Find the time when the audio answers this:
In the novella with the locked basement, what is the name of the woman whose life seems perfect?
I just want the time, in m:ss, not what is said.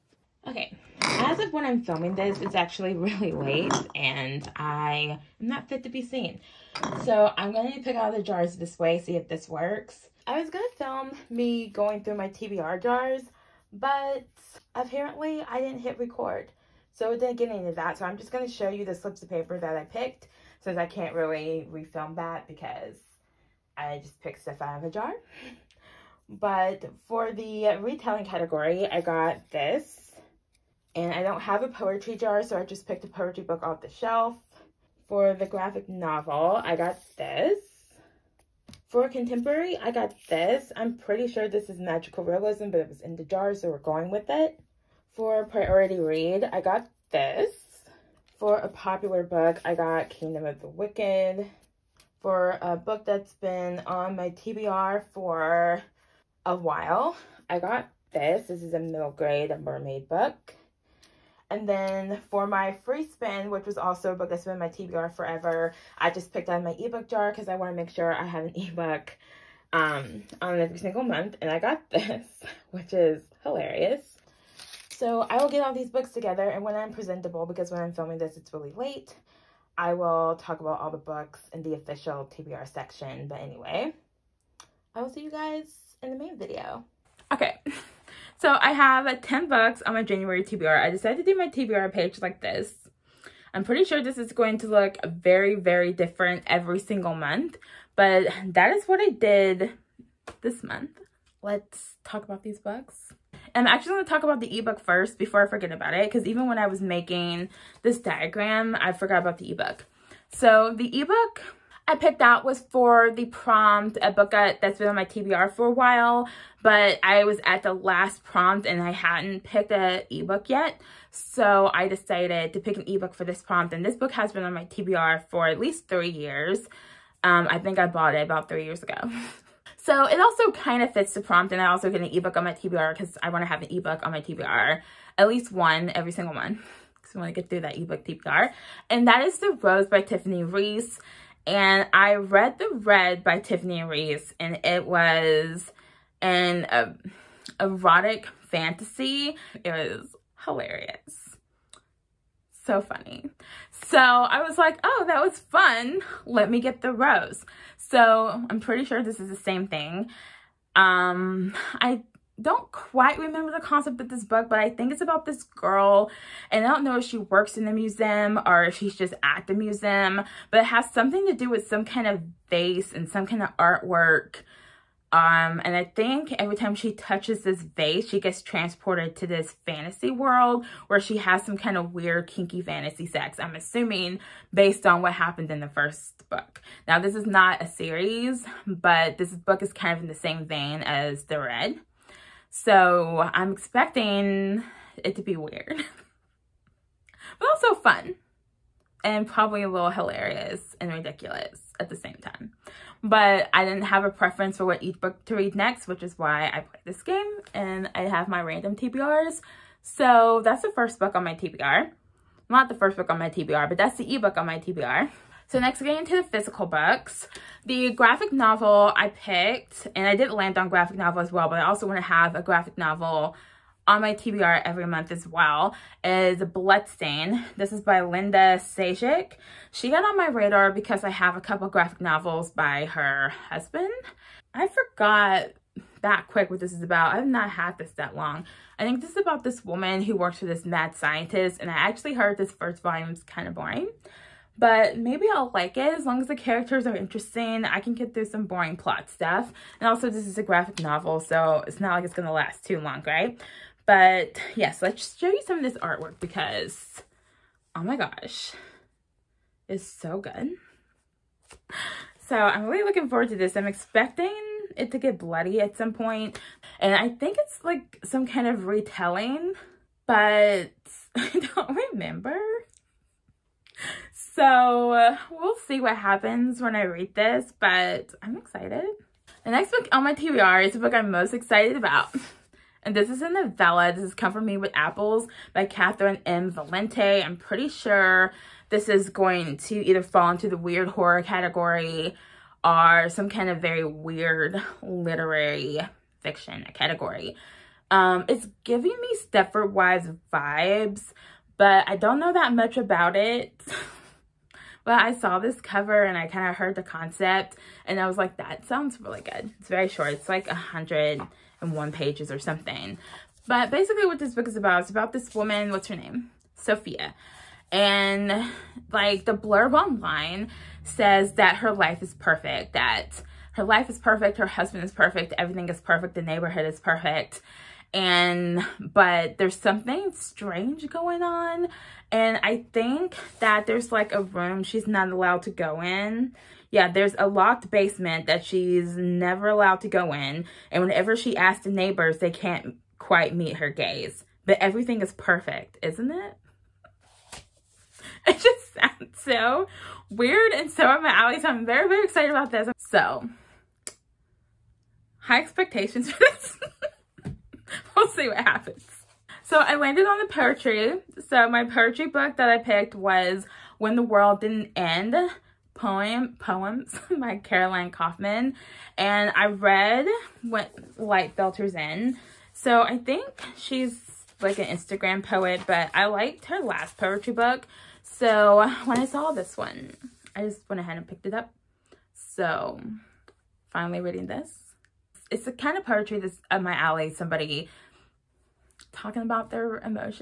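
5:16.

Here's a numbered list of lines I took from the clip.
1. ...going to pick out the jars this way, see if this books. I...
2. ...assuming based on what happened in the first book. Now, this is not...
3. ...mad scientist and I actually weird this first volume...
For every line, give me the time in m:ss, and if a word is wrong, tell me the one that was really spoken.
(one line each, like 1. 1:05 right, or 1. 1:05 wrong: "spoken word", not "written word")
1. 0:07 wrong: "works", not "books"
2. 3:03 right
3. 4:00 wrong: "heard", not "weird".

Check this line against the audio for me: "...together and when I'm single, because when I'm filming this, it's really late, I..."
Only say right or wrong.
wrong.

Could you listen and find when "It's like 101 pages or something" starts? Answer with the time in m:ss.
5:10.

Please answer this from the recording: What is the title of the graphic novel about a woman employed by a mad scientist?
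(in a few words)
Bloodstain.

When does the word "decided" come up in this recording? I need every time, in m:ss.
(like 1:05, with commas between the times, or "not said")
1:30, 2:01.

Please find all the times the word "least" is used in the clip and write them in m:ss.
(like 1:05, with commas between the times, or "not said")
2:05, 2:15.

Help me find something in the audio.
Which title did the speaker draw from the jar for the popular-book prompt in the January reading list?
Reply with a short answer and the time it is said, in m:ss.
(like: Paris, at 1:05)
Kingdom of the Wicked, at 0:50.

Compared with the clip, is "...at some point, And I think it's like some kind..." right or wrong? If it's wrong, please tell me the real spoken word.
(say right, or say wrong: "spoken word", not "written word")
right.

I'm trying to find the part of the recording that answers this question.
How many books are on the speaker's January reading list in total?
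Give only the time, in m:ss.
1:29.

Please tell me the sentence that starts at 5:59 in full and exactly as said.
So I landed on the poetry.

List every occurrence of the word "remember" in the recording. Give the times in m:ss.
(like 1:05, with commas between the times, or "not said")
2:43, 4:31.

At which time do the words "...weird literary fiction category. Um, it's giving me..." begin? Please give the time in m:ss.
4:53.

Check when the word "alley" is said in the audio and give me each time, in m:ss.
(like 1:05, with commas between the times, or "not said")
5:51, 6:26.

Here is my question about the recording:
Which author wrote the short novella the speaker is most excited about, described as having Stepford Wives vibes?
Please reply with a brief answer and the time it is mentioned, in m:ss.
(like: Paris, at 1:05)
Catherynne M. Valente, at 4:45.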